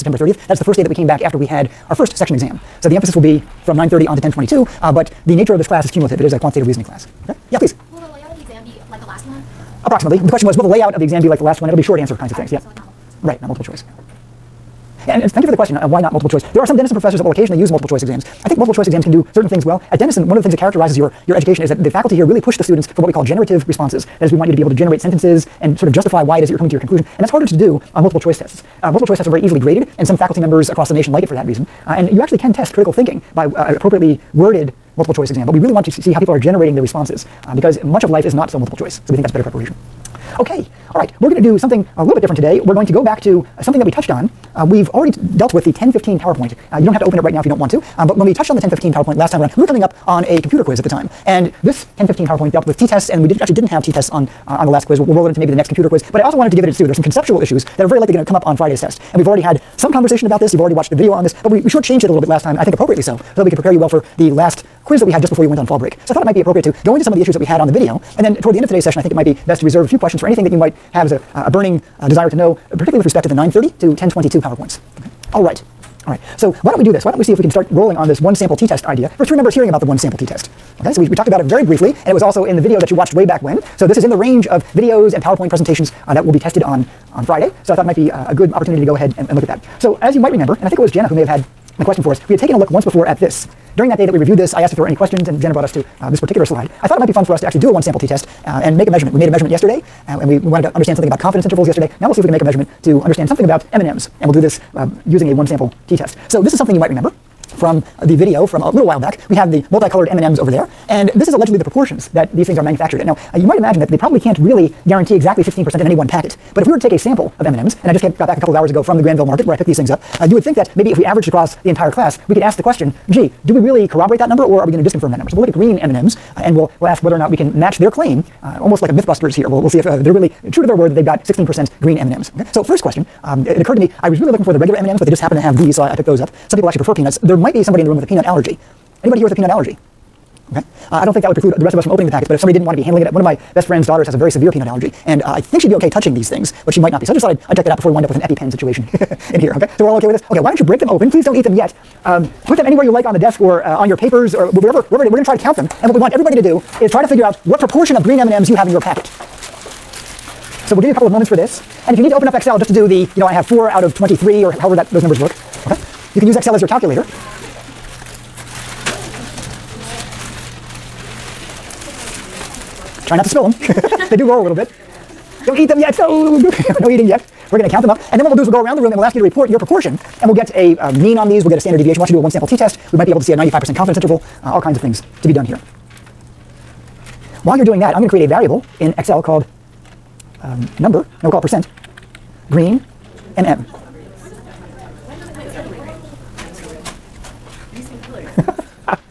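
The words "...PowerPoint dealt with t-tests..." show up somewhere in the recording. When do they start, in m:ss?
0:52.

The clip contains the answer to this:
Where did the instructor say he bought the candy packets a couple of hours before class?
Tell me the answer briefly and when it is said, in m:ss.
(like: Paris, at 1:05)
Granville market, at 1:59.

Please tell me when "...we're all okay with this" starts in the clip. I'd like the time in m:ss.
2:29.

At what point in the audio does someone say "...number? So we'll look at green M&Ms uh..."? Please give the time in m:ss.
2:05.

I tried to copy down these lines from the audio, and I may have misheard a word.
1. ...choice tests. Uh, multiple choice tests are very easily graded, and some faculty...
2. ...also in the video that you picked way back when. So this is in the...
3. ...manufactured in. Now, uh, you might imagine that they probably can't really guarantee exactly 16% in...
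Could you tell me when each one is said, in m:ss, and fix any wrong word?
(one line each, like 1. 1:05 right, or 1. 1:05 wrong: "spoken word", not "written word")
1. 0:28 right
2. 1:22 wrong: "watched", not "picked"
3. 1:52 right.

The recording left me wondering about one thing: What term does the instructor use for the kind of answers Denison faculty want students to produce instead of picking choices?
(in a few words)
generative responses.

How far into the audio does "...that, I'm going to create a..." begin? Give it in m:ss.
3:07.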